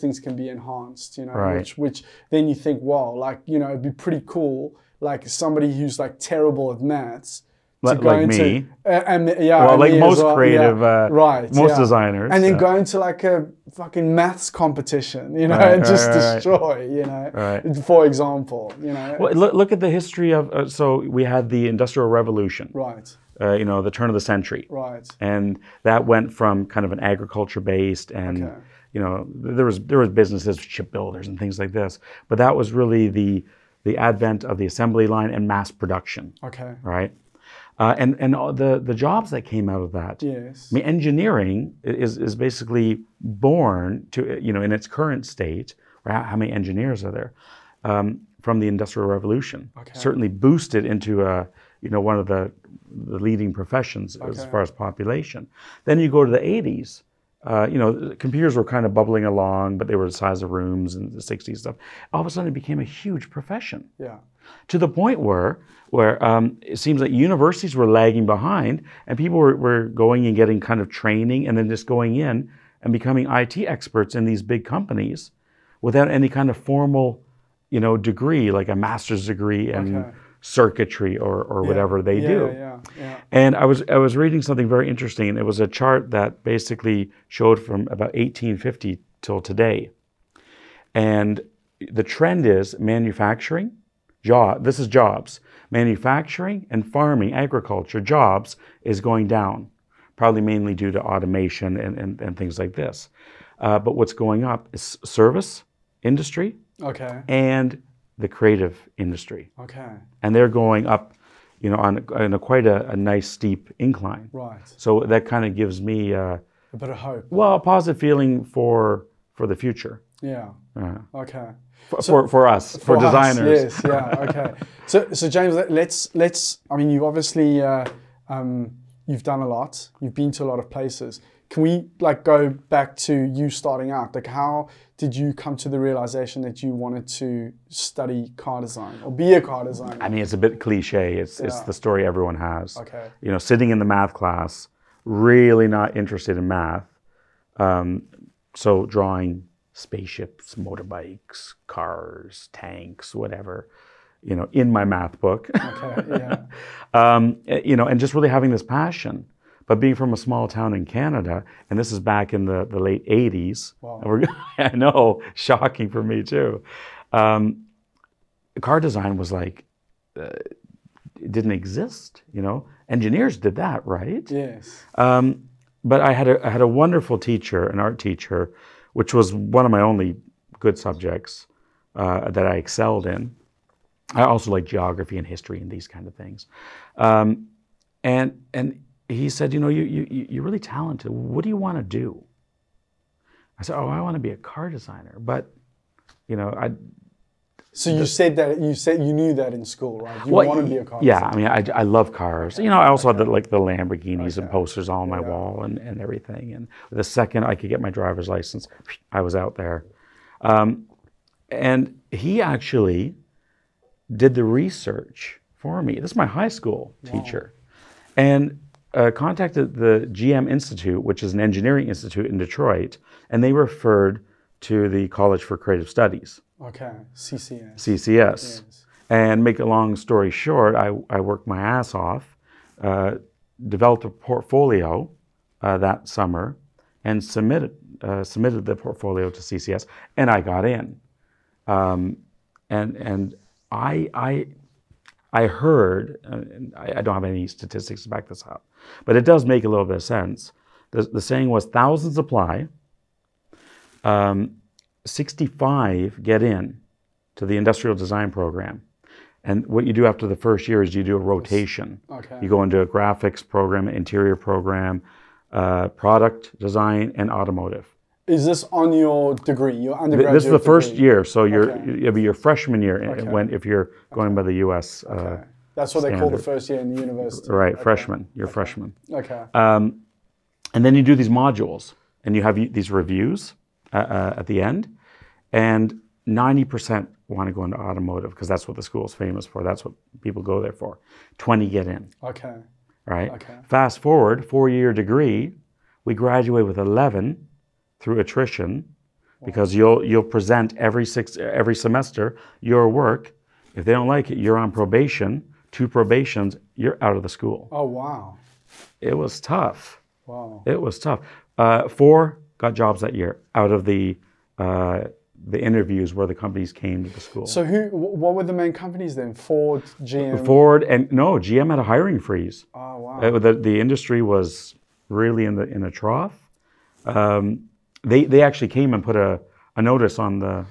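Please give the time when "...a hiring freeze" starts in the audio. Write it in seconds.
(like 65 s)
321 s.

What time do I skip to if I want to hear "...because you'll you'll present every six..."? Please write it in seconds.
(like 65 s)
299 s.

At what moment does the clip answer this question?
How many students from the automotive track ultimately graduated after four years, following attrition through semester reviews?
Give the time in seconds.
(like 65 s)
296 s.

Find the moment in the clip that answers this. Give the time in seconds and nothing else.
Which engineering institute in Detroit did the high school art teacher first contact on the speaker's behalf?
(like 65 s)
220 s.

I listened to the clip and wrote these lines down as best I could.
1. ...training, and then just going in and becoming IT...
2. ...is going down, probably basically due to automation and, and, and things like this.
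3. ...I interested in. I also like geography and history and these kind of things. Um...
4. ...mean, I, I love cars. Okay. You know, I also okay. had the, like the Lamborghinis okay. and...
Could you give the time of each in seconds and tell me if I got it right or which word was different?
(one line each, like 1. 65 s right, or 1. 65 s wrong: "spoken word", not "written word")
1. 70 s right
2. 98 s wrong: "mainly", not "basically"
3. 182 s wrong: "excelled", not "interested"
4. 201 s right.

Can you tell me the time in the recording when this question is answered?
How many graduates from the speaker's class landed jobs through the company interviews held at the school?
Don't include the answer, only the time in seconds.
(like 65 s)
311 s.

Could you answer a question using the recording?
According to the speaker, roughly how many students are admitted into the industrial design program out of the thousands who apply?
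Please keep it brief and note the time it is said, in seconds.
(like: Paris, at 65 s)
65, at 255 s.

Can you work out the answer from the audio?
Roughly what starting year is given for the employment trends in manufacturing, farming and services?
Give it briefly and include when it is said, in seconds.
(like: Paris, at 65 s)
1850, at 88 s.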